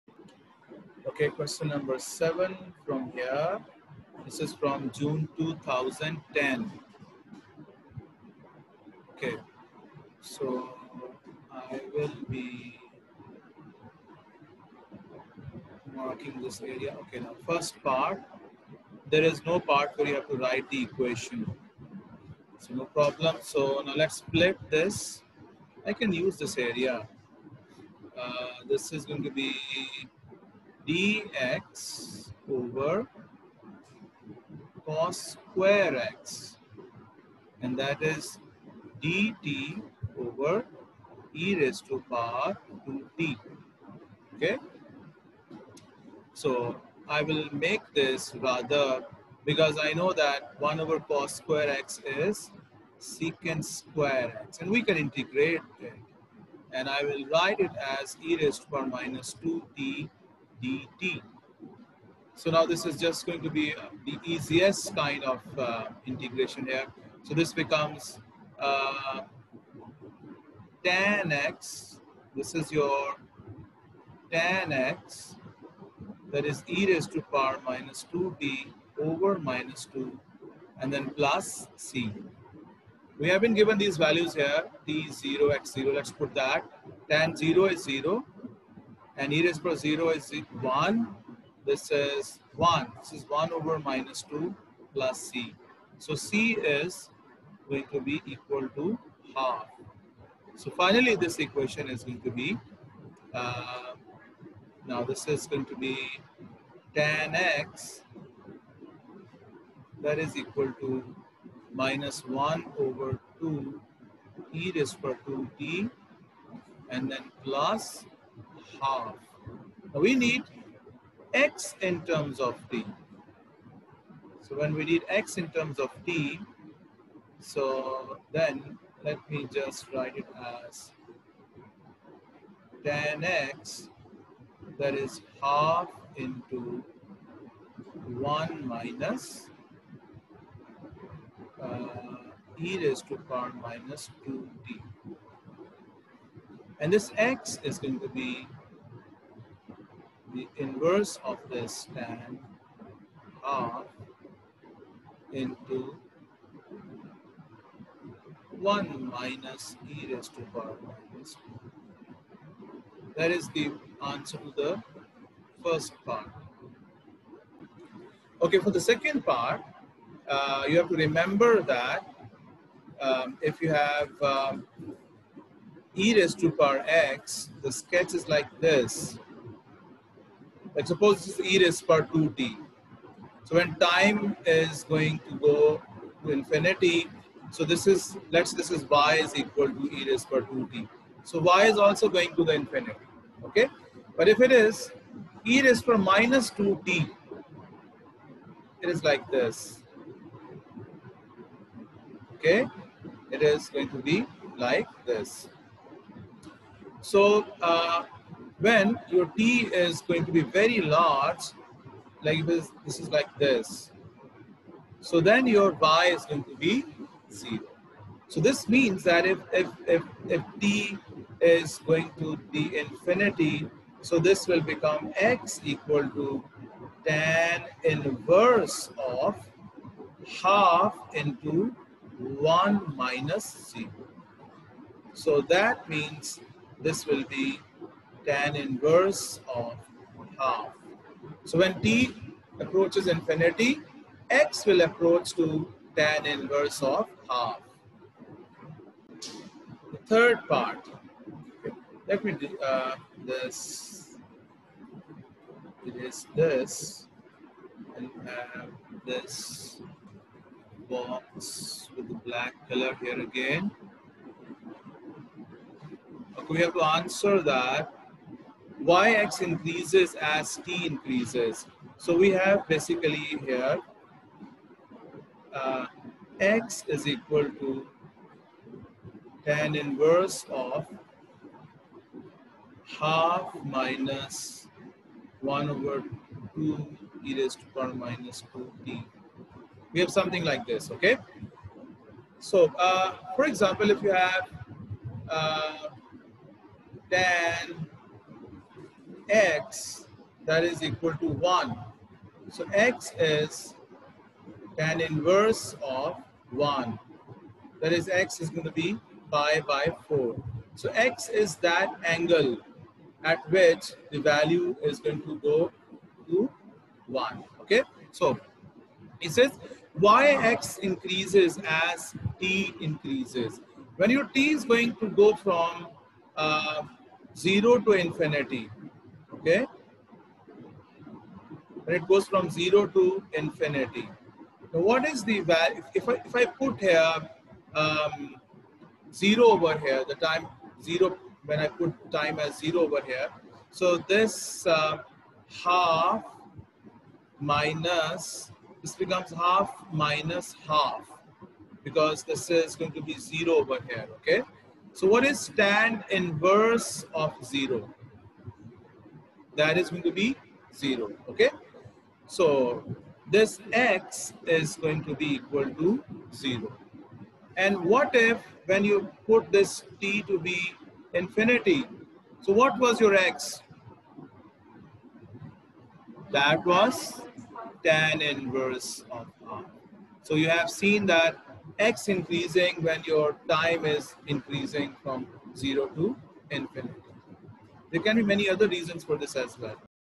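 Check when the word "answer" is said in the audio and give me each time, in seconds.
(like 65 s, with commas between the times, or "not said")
164 s, 266 s.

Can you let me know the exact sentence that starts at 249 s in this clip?
The third part, let me do uh, this, it is this, and have uh, this box with the black color here again.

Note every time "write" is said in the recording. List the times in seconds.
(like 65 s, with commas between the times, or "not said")
20 s, 57 s, 129 s.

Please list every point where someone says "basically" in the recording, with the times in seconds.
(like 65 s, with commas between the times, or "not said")
272 s.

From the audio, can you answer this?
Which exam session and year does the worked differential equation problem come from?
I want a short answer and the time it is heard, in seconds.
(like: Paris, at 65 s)
June 2010, at 4 s.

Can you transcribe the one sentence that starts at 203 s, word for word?
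It is going to be like this.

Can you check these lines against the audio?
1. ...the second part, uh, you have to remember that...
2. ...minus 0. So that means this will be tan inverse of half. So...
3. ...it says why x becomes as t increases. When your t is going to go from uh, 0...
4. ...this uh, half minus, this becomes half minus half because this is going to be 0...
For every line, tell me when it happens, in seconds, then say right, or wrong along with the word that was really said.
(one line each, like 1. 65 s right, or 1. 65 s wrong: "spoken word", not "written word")
1. 168 s right
2. 232 s right
3. 319 s wrong: "increases", not "becomes"
4. 343 s right.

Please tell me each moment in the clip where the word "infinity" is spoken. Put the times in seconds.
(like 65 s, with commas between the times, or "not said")
186 s, 192 s, 222 s, 243 s, 327 s, 333 s, 371 s, 386 s.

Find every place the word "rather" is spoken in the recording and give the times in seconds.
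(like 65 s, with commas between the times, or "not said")
48 s.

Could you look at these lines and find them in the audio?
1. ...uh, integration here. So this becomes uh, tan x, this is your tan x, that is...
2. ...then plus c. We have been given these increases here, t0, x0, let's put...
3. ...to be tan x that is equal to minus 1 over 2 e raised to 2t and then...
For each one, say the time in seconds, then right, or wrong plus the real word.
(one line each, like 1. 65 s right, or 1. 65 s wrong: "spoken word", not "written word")
1. 65 s right
2. 80 s wrong: "values", not "increases"
3. 105 s right.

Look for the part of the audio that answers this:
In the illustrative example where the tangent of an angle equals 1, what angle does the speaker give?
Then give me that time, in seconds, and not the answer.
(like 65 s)
309 s.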